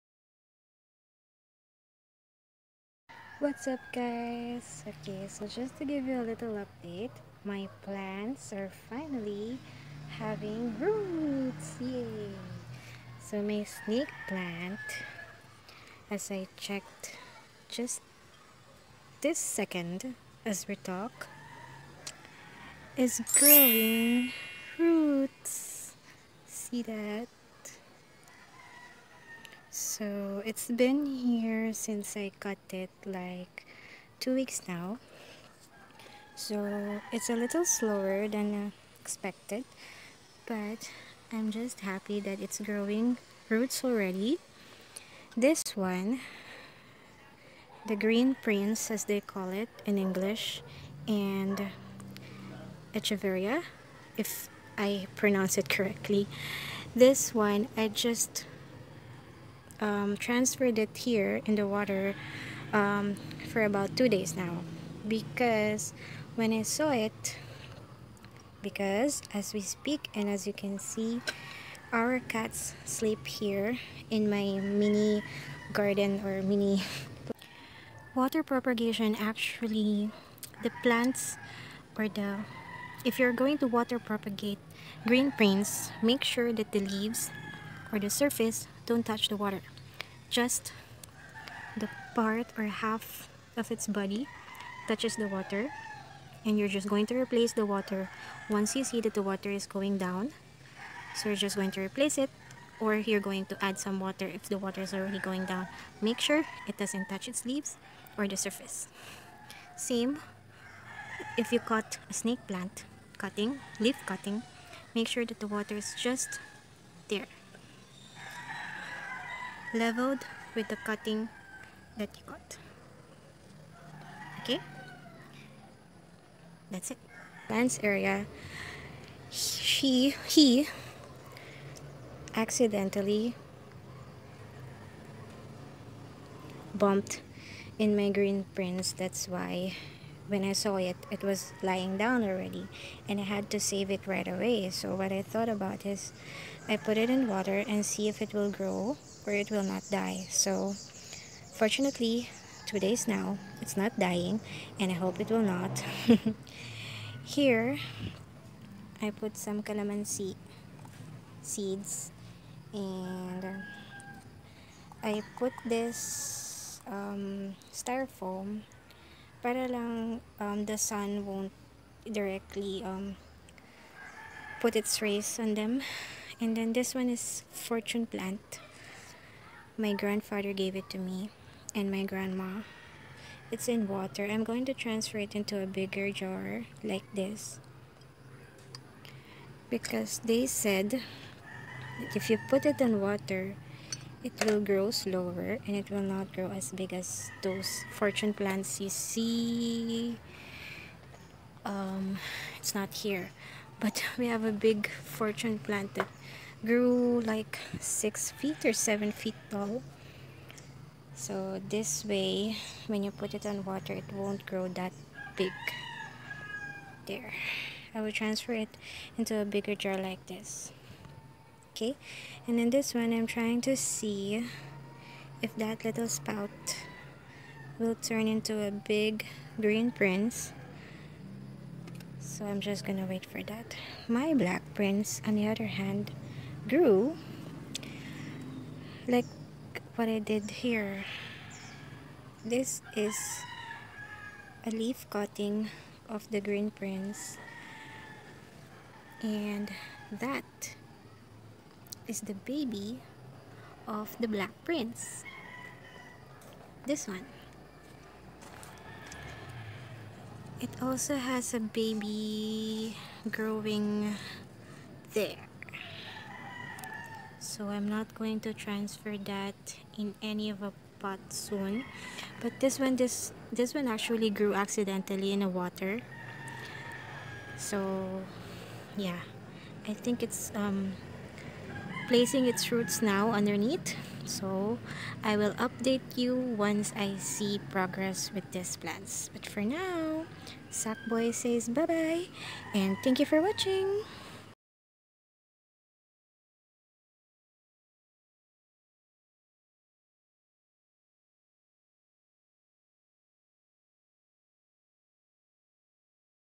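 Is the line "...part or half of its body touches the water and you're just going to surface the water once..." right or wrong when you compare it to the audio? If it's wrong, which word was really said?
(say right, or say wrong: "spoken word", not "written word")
wrong: "replace", not "surface".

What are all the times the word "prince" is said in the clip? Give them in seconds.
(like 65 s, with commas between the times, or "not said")
48 s, 85 s, 138 s, 229 s, 234 s, 246 s, 254 s.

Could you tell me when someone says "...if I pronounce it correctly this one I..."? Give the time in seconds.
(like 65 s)
54 s.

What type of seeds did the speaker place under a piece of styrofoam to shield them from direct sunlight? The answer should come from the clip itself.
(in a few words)
Calamansi.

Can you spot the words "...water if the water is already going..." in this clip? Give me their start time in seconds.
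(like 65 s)
103 s.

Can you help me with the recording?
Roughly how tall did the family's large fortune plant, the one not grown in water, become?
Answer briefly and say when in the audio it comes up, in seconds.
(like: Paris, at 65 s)
6 or 7 feet, at 207 s.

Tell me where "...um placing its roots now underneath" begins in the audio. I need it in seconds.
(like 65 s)
280 s.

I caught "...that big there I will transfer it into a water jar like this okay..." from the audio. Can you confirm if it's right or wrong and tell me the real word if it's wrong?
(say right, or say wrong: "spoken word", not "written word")
wrong: "bigger", not "water".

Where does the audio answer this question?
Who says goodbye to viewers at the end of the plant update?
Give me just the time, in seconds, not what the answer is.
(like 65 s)
290 s.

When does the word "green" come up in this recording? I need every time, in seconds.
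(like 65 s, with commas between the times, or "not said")
47 s, 85 s, 138 s, 229 s, 246 s.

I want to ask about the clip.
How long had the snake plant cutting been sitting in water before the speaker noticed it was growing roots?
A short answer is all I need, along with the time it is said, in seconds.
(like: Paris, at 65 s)
2 weeks, at 34 s.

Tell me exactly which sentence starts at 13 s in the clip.
So my snake plant, as I checked just this second as we talk, is growing roots!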